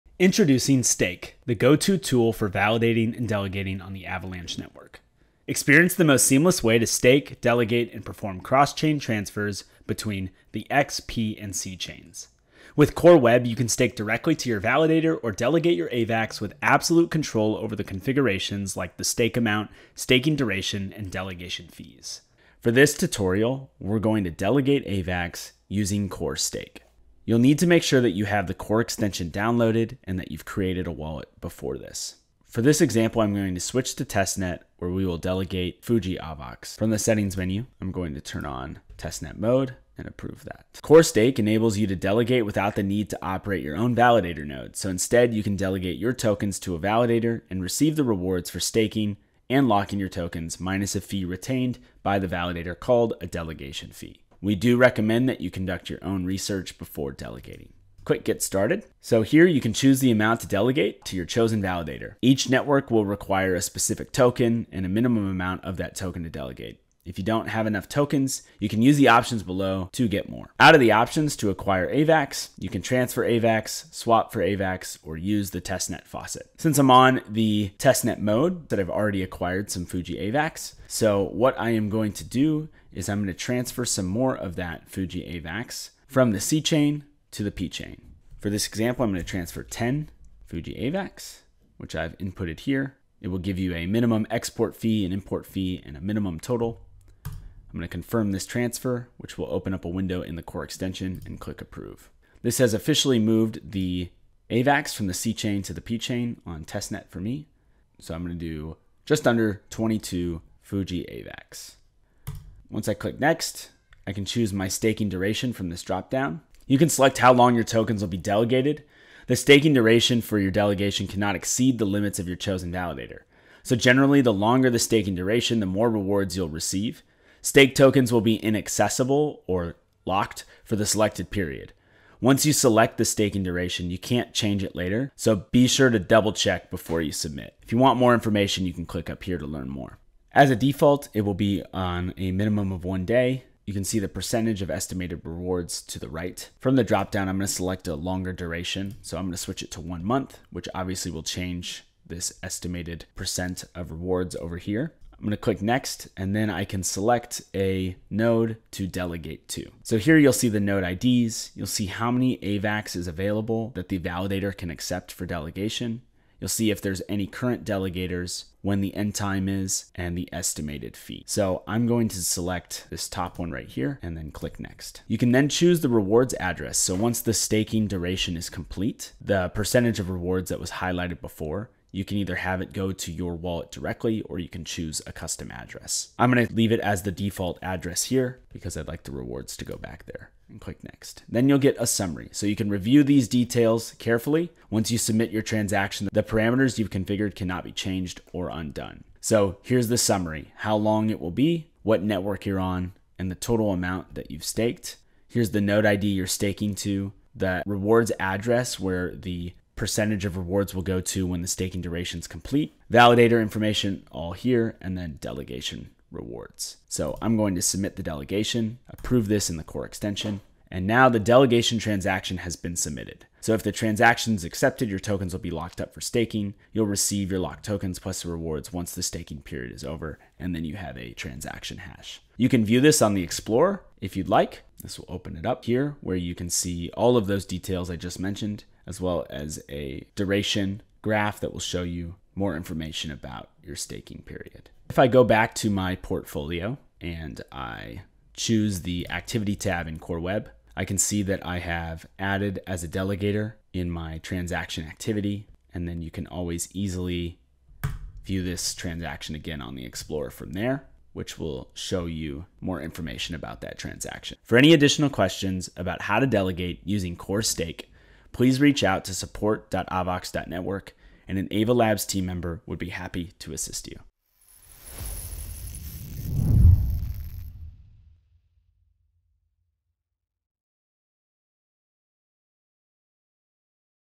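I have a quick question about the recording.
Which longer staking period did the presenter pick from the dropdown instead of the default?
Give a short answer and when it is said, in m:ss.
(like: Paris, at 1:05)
one month, at 2:29.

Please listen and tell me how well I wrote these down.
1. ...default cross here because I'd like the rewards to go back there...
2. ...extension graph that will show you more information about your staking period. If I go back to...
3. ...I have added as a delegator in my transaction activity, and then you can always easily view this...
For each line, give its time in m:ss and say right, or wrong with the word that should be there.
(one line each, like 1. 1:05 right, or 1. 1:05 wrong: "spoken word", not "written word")
1. 3:07 wrong: "address", not "cross"
2. 4:00 wrong: "duration", not "extension"
3. 4:11 right.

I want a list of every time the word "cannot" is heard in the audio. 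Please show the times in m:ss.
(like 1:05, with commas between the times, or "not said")
2:01, 3:17.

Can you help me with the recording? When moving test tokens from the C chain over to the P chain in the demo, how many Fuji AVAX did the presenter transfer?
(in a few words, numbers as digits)
10.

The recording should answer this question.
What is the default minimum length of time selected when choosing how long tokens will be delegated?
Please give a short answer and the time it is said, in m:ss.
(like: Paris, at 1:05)
one day, at 2:22.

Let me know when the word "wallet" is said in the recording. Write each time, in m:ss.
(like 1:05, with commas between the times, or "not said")
0:30, 3:03.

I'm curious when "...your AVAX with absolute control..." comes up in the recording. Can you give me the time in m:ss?
0:15.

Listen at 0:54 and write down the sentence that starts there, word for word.
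We do recommend that you conduct your own research before delegating.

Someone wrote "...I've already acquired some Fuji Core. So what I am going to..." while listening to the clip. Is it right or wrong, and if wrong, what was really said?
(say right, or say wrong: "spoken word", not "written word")
wrong: "AVAX", not "Core".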